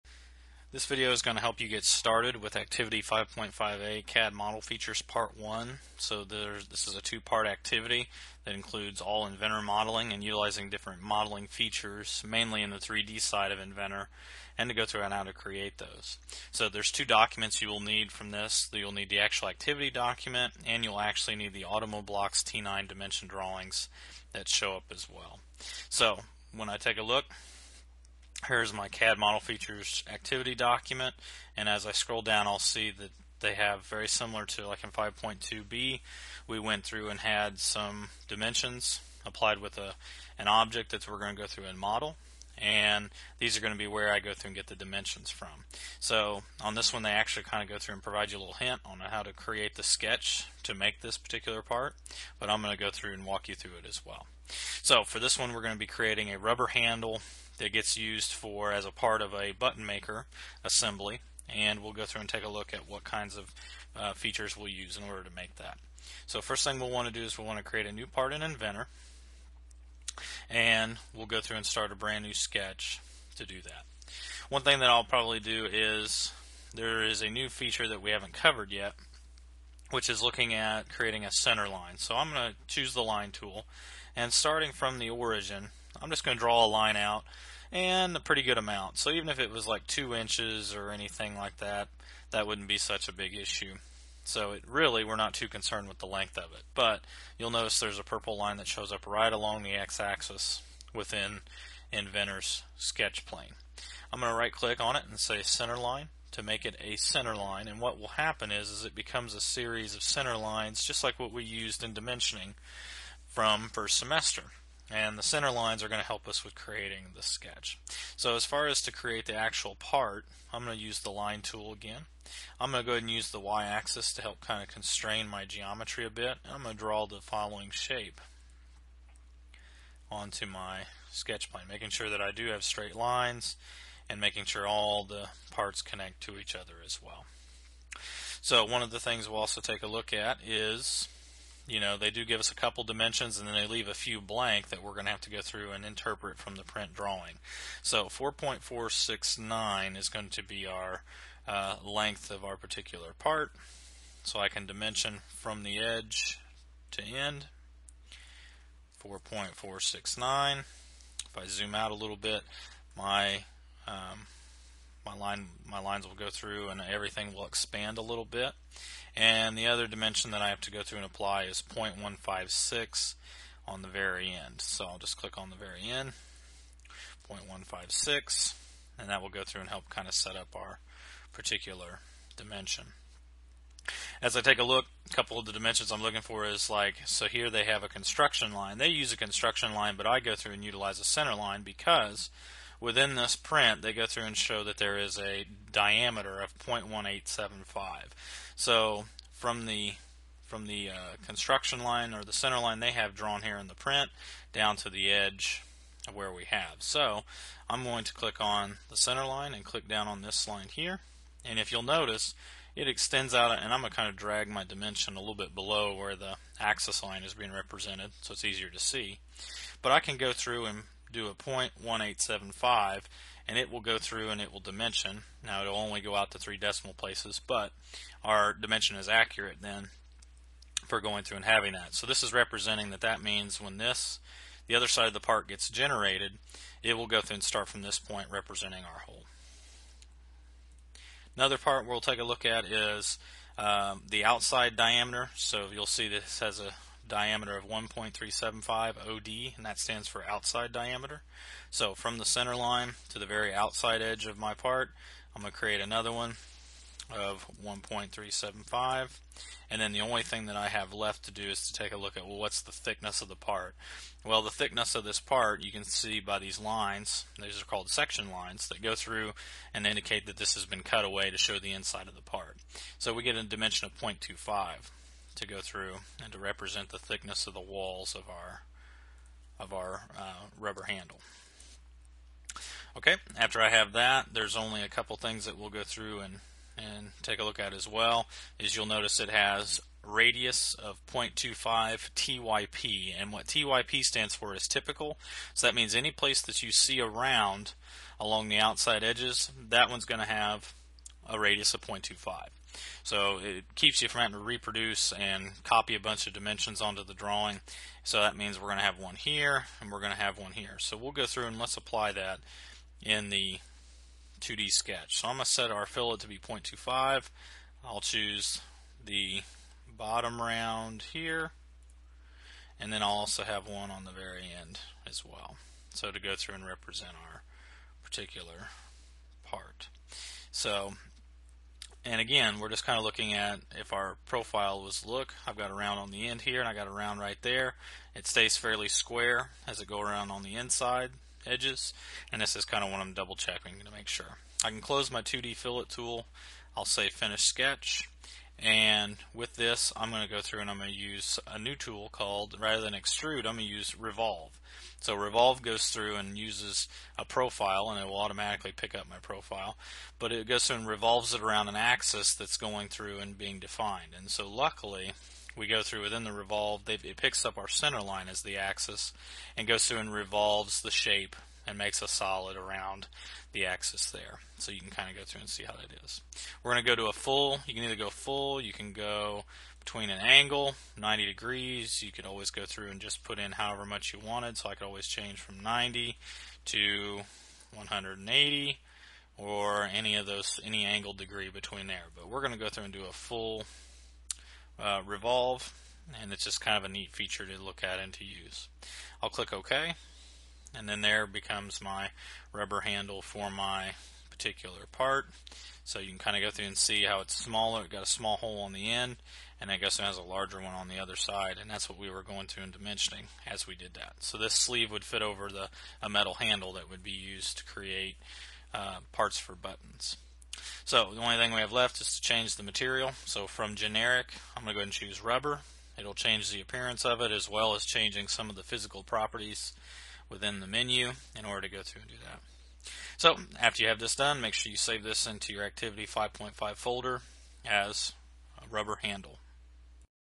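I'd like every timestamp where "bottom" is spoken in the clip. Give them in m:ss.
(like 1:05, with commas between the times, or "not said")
5:19.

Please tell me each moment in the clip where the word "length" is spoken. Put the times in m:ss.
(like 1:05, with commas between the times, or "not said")
1:36, 2:31.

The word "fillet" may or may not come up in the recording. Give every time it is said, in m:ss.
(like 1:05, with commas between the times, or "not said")
5:15, 5:45.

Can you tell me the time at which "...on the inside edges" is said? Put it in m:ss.
5:40.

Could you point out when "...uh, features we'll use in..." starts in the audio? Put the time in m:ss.
1:03.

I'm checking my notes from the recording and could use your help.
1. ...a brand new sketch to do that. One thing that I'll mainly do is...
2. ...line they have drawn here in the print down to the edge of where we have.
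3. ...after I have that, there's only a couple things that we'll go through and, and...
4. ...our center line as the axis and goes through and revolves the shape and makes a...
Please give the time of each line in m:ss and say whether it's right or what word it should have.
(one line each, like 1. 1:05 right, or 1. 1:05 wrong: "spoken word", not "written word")
1. 1:11 wrong: "probably", not "mainly"
2. 3:22 right
3. 4:43 right
4. 6:07 right.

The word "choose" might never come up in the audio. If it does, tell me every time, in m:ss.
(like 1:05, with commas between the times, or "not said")
1:22, 5:18, 7:04.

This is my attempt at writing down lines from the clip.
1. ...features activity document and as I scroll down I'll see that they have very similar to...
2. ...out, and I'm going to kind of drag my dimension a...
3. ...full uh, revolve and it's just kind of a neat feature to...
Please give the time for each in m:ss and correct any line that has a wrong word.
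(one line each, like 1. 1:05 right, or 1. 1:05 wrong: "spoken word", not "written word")
1. 0:29 right
2. 3:33 right
3. 6:33 right.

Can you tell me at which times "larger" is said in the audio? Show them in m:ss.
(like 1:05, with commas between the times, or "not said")
6:50.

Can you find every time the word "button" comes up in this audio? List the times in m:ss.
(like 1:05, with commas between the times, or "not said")
0:59, 6:59.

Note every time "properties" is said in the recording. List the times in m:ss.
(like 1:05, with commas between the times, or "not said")
7:09.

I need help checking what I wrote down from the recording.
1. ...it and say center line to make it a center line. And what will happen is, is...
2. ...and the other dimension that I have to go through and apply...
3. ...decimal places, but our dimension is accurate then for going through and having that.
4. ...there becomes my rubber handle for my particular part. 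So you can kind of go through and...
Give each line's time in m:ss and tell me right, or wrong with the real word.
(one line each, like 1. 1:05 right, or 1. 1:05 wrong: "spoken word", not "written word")
1. 1:44 right
2. 2:49 right
3. 3:46 right
4. 6:41 right.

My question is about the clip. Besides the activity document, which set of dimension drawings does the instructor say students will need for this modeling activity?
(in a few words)
Automoblox T9.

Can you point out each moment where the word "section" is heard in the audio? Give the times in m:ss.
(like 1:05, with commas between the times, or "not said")
4:27.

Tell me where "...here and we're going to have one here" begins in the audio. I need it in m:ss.
5:09.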